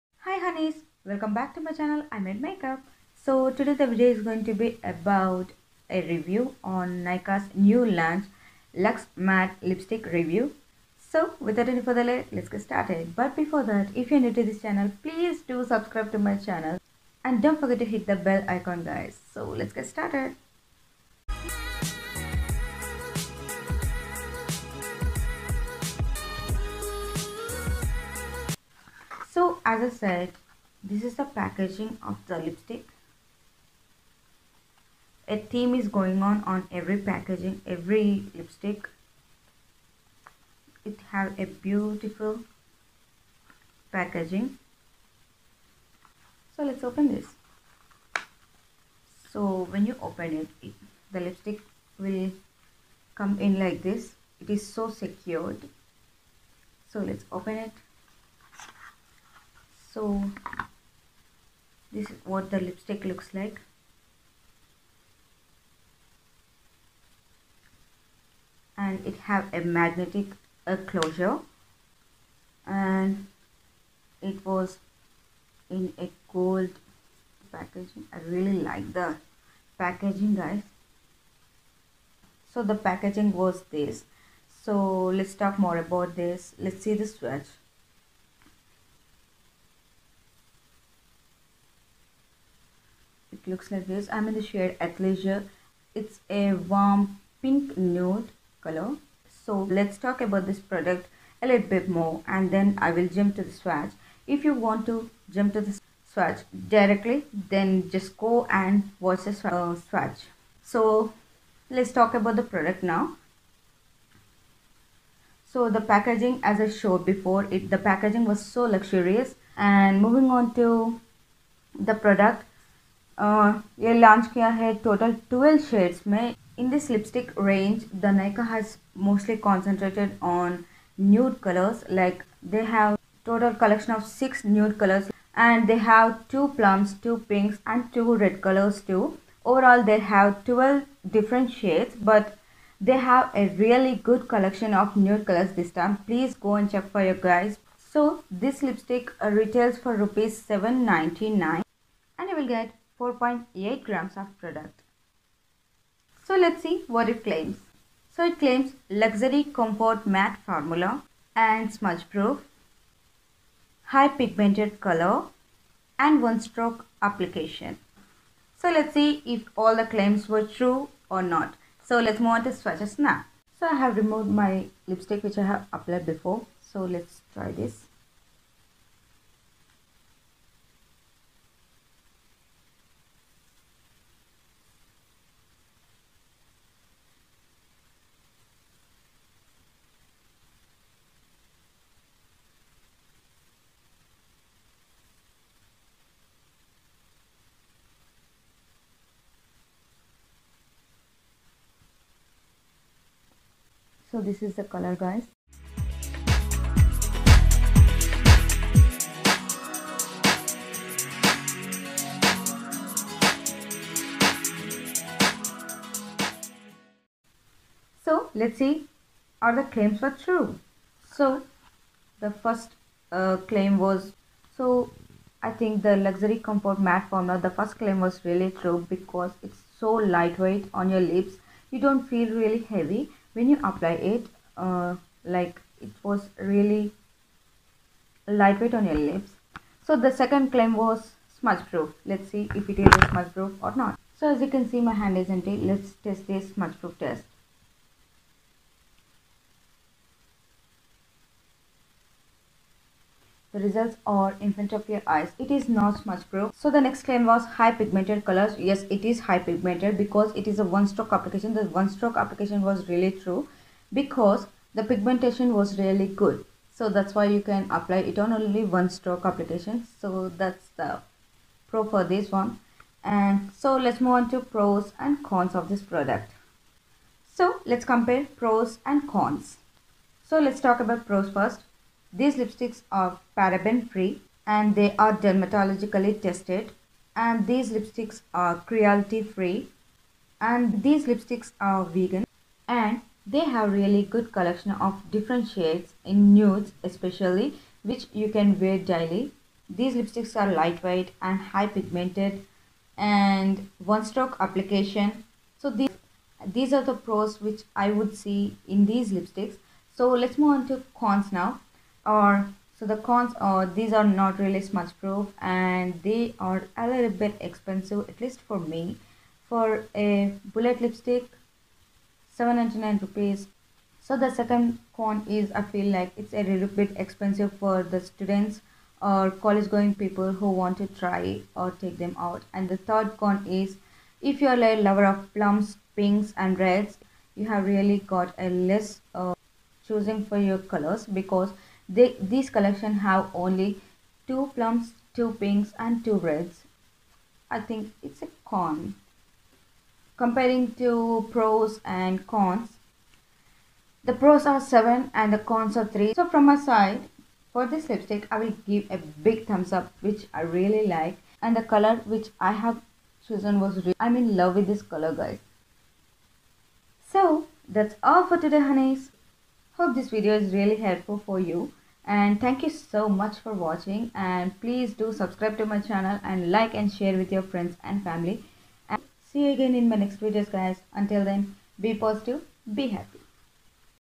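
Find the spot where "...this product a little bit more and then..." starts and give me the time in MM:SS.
01:40.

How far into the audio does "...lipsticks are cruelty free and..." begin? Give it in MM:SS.
04:47.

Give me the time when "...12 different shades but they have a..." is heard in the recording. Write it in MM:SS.
02:20.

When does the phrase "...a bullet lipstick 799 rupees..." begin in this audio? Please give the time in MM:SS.
05:19.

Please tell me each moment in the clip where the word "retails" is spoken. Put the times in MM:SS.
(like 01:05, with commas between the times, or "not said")
02:29.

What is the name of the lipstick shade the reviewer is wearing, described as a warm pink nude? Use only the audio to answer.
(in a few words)
Athleisure.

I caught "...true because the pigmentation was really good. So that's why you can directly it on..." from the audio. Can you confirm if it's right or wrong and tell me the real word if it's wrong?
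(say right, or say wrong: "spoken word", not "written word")
wrong: "apply", not "directly".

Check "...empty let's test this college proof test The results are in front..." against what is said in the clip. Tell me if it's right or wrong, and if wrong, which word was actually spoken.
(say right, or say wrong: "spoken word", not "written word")
wrong: "smudge", not "college".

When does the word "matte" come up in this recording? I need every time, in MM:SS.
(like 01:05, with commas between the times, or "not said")
00:09, 02:40, 03:46.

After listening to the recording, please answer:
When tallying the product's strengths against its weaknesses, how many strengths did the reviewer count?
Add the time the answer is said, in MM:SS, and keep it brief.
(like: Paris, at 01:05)
7, at 05:54.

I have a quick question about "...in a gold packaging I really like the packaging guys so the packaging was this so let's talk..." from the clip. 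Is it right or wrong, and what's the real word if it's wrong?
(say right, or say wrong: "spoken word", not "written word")
right.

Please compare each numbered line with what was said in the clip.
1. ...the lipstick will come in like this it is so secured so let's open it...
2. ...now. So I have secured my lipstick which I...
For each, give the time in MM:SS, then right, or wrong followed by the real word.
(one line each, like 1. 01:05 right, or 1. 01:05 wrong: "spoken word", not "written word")
1. 00:51 right
2. 02:52 wrong: "removed", not "secured".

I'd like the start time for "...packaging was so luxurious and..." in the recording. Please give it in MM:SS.
01:57.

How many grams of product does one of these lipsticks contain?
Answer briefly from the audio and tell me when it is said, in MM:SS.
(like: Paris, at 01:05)
4.8 grams, at 02:33.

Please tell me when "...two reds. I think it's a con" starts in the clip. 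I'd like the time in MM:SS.
05:46.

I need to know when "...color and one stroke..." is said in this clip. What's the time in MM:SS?
02:44.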